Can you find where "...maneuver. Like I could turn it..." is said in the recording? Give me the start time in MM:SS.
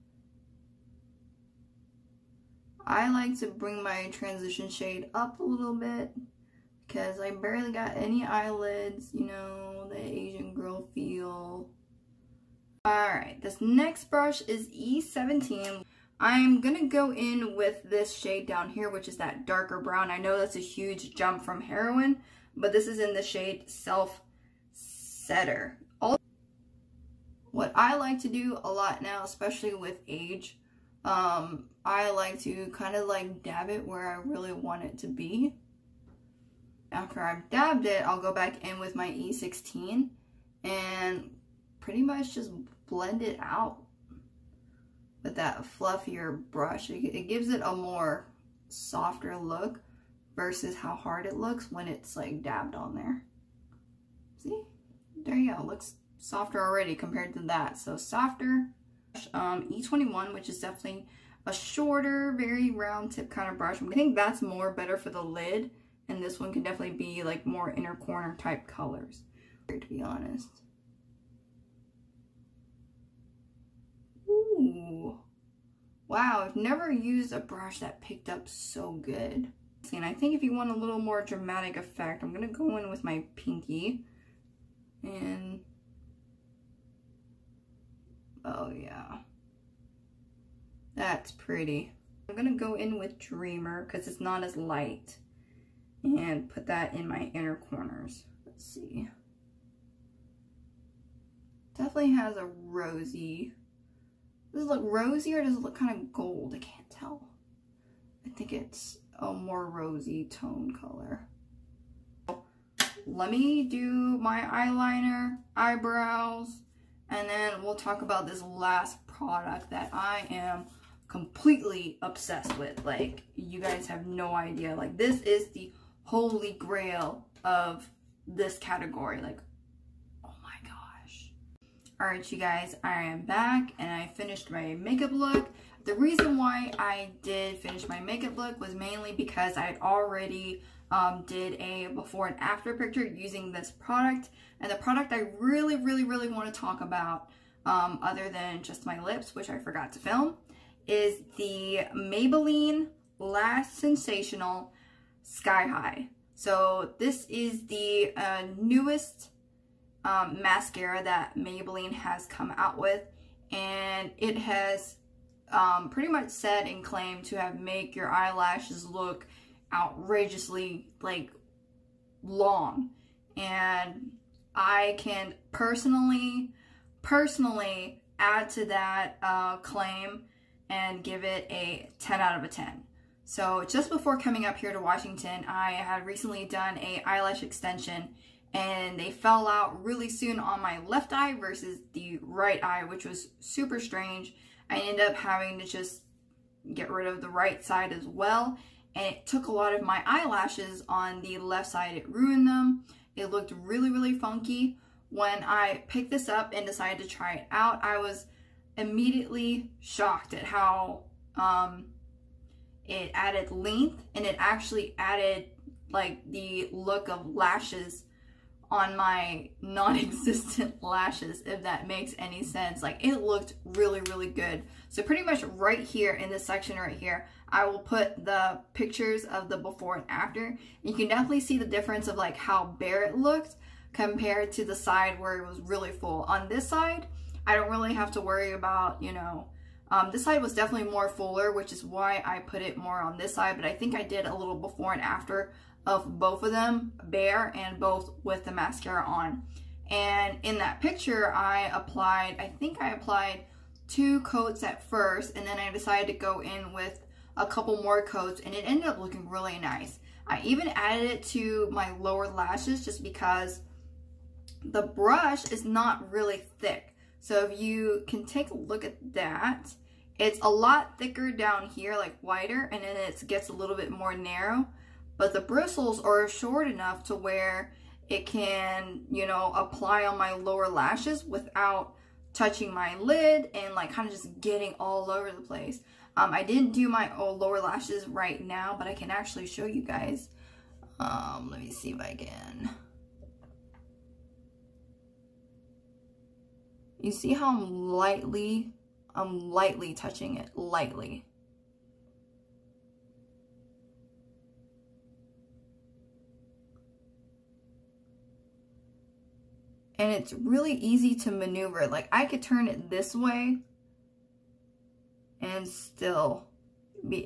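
05:11.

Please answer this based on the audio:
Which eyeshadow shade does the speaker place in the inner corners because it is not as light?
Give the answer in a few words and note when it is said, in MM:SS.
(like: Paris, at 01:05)
Dreamer, at 01:33.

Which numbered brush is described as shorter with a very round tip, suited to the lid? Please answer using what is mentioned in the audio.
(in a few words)
E21.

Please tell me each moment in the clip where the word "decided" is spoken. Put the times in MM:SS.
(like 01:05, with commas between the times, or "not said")
03:26, 04:15.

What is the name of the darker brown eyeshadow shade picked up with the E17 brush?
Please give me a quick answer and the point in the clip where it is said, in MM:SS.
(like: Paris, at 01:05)
Self Setter, at 00:23.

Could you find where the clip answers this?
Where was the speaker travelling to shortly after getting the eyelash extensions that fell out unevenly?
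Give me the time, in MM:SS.
03:04.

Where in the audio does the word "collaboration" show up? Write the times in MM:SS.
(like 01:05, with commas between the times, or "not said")
not said.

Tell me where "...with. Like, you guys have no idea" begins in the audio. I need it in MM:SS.
02:02.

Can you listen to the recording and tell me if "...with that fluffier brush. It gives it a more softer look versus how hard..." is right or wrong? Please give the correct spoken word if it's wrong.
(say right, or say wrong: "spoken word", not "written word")
right.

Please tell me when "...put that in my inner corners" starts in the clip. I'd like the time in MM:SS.
01:36.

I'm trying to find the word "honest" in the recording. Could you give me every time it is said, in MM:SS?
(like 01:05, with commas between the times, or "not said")
01:10.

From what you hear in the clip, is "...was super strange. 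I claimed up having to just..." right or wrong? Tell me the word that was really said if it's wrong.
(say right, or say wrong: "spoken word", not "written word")
wrong: "ended", not "claimed".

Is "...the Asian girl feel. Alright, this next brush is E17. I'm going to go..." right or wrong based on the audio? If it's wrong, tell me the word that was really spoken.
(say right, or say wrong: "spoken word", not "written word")
right.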